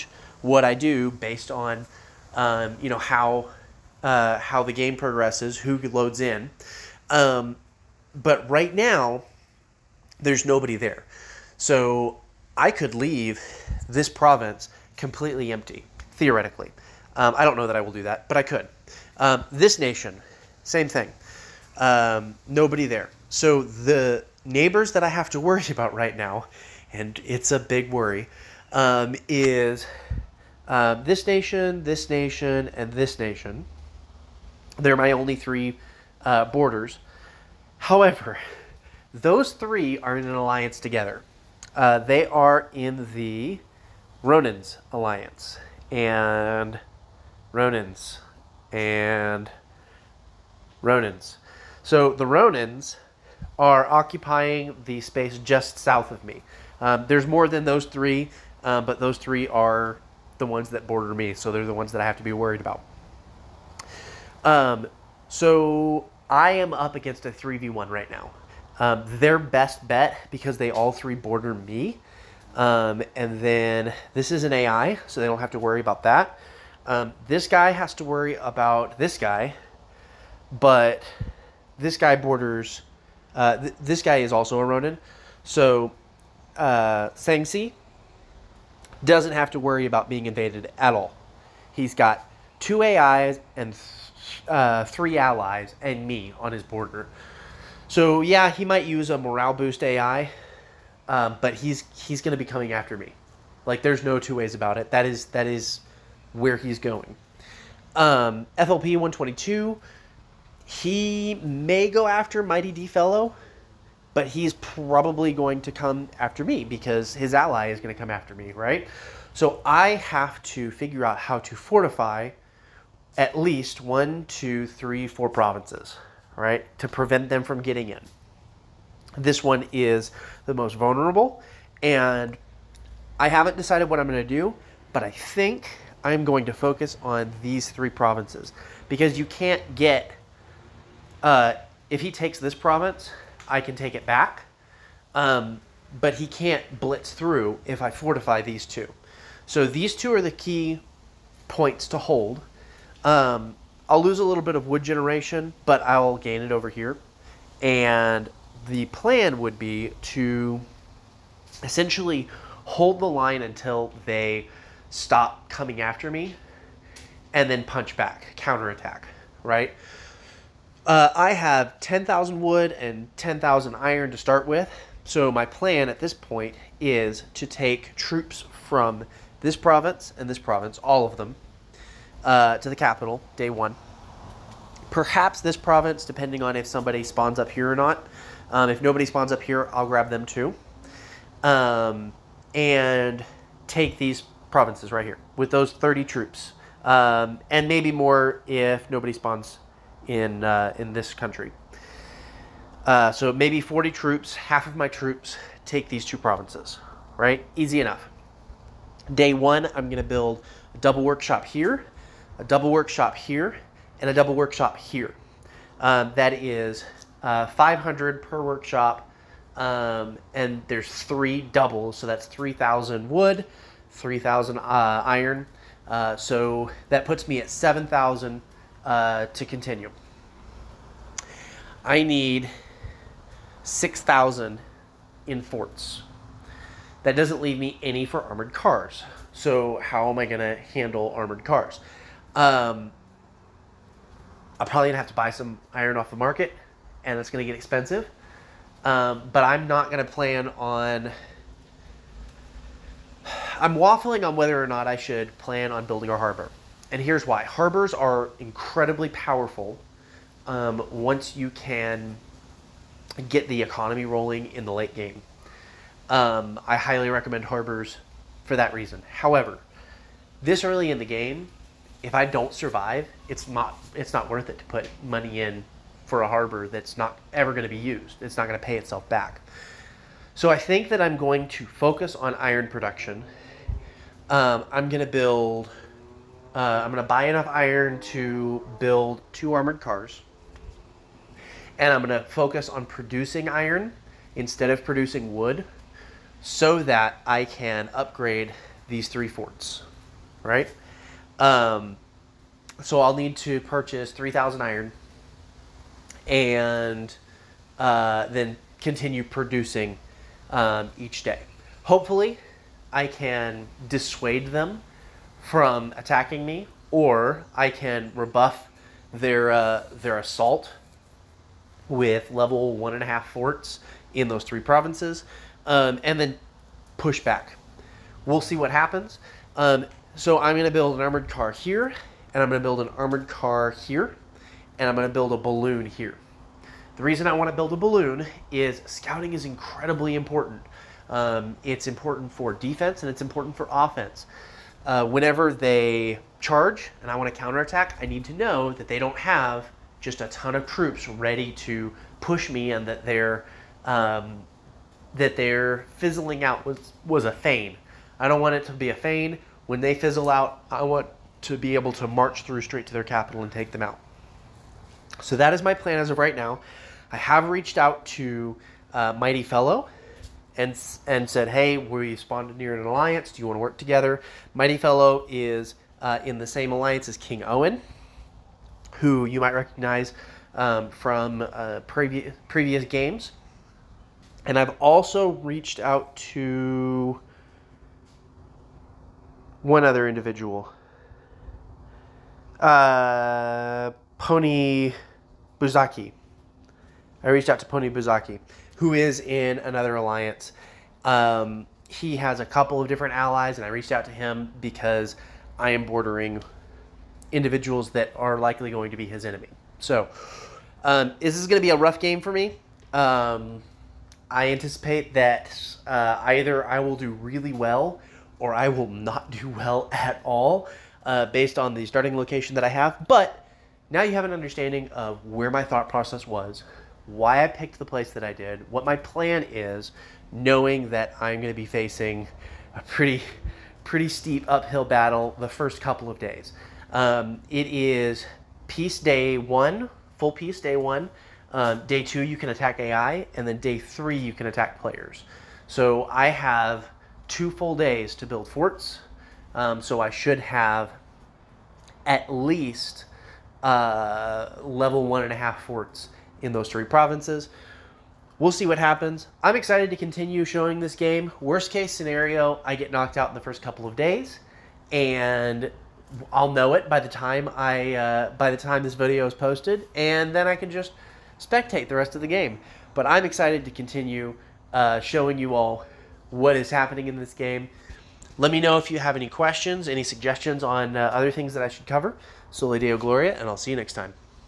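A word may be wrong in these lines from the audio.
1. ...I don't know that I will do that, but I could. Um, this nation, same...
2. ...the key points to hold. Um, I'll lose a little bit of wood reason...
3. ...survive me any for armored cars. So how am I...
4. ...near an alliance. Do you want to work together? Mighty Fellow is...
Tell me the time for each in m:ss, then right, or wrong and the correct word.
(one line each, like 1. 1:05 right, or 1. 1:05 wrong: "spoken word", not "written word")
1. 0:17 right
2. 2:30 wrong: "generation", not "reason"
3. 3:57 wrong: "leave", not "survive"
4. 6:12 right.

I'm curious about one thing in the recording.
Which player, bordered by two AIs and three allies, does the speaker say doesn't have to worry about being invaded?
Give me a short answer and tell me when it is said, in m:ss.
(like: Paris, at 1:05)
Sangsi, at 1:27.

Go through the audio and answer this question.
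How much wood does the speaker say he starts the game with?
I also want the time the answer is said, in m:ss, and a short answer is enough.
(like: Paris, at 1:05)
10,000, at 2:51.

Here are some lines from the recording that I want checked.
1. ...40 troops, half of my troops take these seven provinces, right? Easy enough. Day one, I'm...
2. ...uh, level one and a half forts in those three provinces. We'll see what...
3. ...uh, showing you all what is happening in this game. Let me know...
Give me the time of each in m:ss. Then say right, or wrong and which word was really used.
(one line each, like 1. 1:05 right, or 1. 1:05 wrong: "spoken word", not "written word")
1. 3:23 wrong: "two", not "seven"
2. 7:33 right
3. 7:54 right.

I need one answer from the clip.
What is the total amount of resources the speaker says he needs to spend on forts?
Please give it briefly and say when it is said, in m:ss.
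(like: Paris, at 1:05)
6,000, at 3:53.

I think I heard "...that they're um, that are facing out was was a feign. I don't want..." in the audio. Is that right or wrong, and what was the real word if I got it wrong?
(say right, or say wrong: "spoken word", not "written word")
wrong: "fizzling", not "facing".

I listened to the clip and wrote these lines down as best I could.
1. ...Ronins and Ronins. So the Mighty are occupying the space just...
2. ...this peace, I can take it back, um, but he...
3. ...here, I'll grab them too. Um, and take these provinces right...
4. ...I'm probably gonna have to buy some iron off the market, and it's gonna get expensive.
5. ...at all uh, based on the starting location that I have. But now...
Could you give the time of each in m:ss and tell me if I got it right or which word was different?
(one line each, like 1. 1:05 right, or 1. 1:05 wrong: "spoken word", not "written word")
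1. 0:47 wrong: "Ronins", not "Mighty"
2. 2:22 wrong: "province", not "peace"
3. 3:09 right
4. 4:04 right
5. 6:59 right.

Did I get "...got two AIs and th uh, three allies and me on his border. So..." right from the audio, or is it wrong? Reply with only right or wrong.
right.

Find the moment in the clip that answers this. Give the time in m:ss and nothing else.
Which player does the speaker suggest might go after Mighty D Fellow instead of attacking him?
1:48.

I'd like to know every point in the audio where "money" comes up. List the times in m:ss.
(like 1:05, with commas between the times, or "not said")
4:35.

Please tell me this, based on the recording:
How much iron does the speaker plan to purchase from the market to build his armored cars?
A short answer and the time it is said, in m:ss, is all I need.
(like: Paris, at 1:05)
3,000, at 5:04.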